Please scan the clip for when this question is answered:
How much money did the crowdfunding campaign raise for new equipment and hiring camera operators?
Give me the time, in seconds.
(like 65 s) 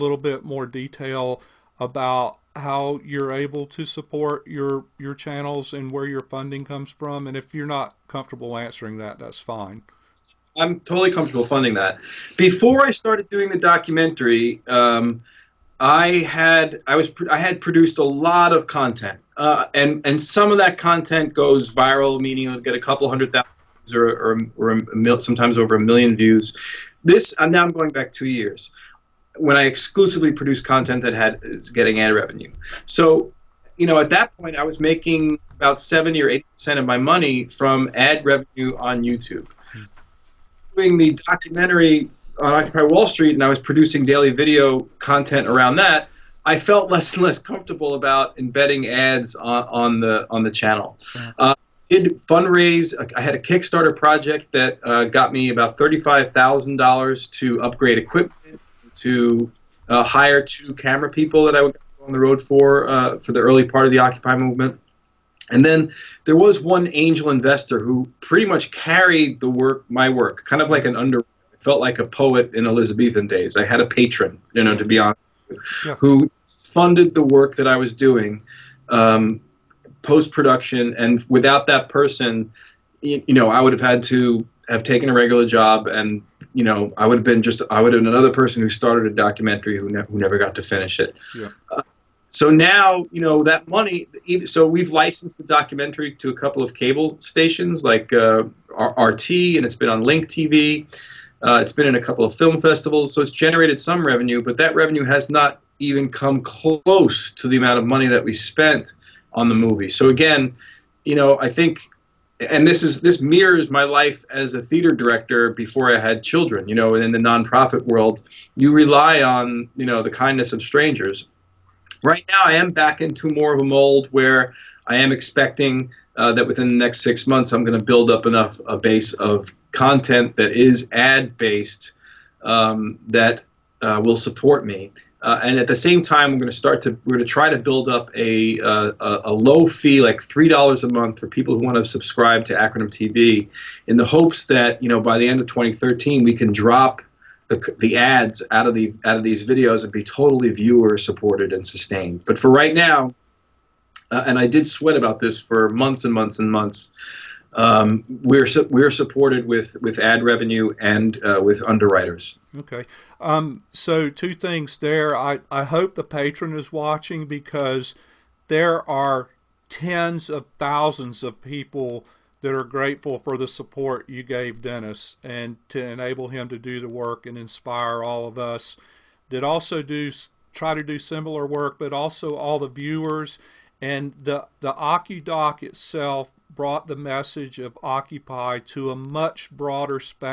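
55 s.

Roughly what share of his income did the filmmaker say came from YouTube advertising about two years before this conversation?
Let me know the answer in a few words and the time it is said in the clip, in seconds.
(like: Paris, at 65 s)
70 or 80 percent, at 35 s.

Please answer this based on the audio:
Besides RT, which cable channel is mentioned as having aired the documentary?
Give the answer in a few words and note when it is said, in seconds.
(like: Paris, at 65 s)
Link TV, at 100 s.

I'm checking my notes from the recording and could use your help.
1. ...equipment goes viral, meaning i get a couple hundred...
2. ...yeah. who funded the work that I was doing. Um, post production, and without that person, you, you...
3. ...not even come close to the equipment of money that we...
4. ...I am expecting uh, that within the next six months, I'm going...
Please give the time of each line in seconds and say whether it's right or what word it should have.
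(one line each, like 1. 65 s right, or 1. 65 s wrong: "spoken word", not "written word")
1. 20 s wrong: "content", not "equipment"
2. 75 s right
3. 105 s wrong: "amount", not "equipment"
4. 124 s right.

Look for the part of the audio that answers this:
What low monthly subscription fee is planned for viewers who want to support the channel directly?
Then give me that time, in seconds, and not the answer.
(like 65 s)
140 s.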